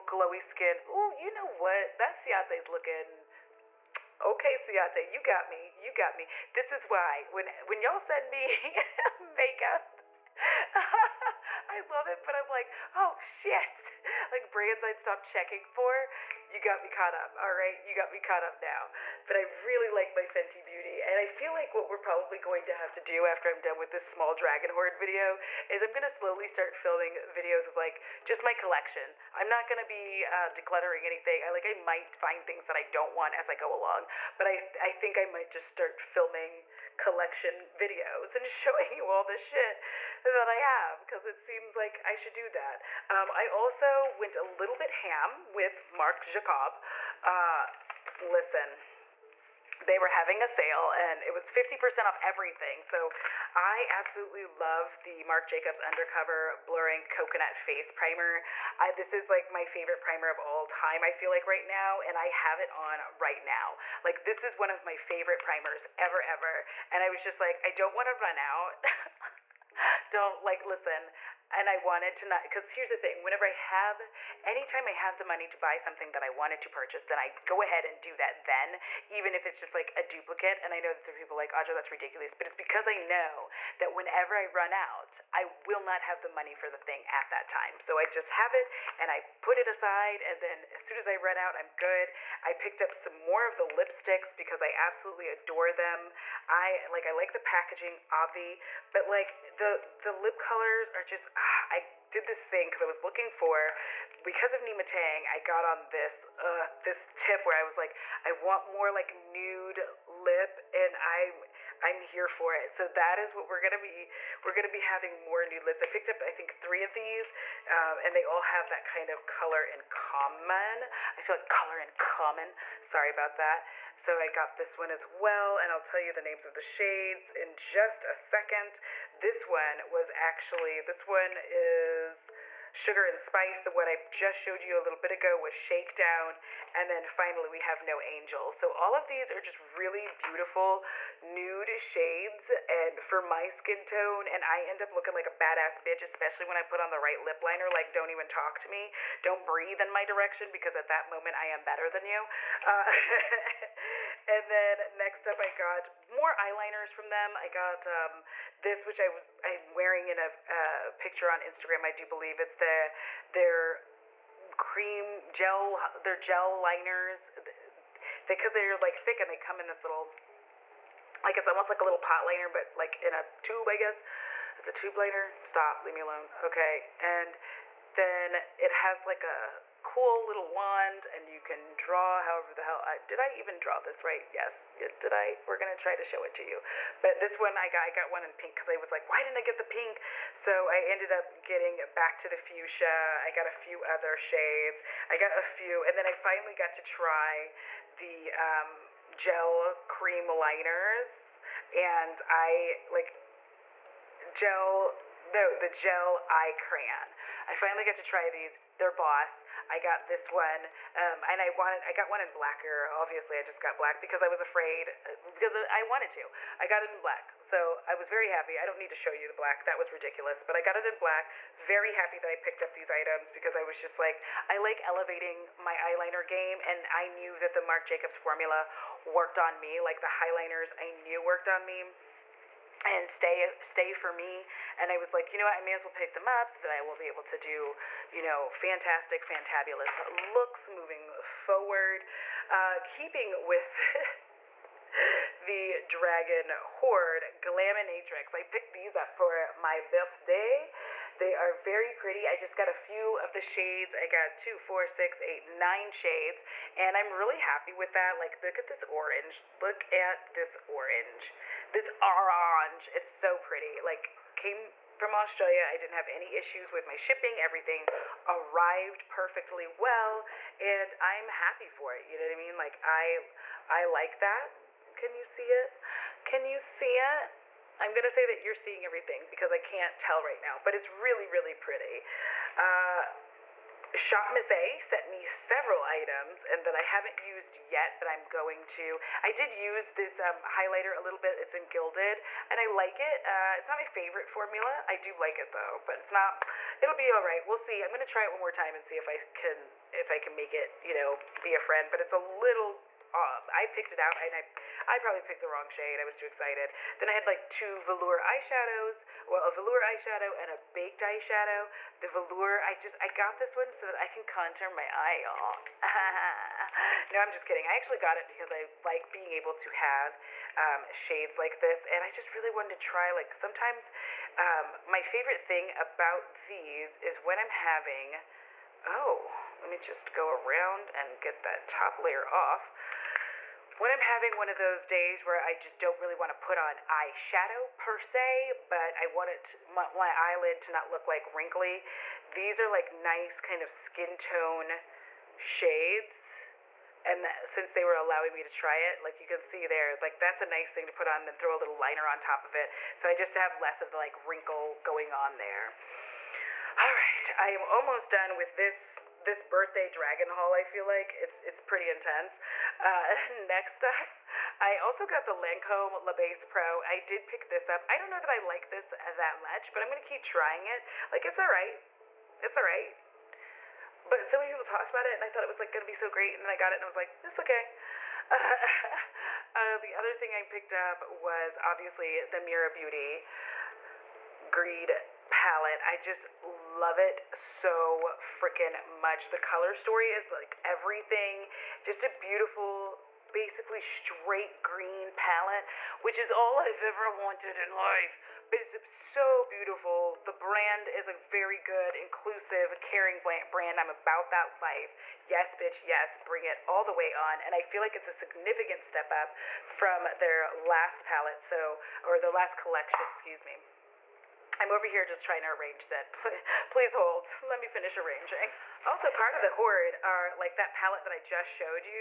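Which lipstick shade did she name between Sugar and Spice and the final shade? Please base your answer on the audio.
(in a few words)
Shakedown.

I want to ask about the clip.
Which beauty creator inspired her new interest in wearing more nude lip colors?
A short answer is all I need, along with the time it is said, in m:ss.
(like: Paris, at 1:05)
Nyma Tang, at 1:44.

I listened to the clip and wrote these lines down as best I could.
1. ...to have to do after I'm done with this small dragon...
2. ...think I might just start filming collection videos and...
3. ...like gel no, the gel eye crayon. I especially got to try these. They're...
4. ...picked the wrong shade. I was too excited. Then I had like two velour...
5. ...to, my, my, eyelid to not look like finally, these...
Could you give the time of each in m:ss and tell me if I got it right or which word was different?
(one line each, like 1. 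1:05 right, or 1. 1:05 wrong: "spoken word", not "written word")
1. 0:22 right
2. 0:34 right
3. 3:22 wrong: "finally", not "especially"
4. 5:05 right
5. 5:39 wrong: "wrinkly", not "finally".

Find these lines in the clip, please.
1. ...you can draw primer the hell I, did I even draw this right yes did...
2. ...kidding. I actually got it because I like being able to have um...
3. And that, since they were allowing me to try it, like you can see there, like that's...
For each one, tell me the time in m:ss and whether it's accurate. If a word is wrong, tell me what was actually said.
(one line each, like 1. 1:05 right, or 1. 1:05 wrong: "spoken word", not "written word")
1. 3:01 wrong: "however", not "primer"
2. 5:17 right
3. 5:47 right.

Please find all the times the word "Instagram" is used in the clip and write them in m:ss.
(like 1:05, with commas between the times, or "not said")
2:41.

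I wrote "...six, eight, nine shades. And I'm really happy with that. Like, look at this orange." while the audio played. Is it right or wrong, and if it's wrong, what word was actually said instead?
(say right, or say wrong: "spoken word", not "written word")
right.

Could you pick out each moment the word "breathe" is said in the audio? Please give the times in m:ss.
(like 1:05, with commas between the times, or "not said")
2:29.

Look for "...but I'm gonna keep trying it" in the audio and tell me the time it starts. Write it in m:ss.
6:09.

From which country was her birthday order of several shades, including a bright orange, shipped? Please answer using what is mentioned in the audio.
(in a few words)
Australia.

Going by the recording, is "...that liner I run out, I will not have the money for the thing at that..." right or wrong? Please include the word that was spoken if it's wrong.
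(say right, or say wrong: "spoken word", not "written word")
wrong: "whenever", not "liner".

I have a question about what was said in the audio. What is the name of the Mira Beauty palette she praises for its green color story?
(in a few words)
Greed.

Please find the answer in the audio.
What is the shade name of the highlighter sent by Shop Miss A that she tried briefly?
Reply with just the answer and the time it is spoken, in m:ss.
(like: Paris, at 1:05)
Gilded, at 4:51.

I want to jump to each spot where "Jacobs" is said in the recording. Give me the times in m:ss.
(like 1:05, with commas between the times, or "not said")
0:46, 0:55, 3:47.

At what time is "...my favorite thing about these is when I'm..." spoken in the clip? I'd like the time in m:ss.
5:24.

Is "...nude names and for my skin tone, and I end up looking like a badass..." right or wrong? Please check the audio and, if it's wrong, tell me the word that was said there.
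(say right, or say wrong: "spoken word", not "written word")
wrong: "shades", not "names".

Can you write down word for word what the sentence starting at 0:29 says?
I'm not gonna be uh, decluttering anything.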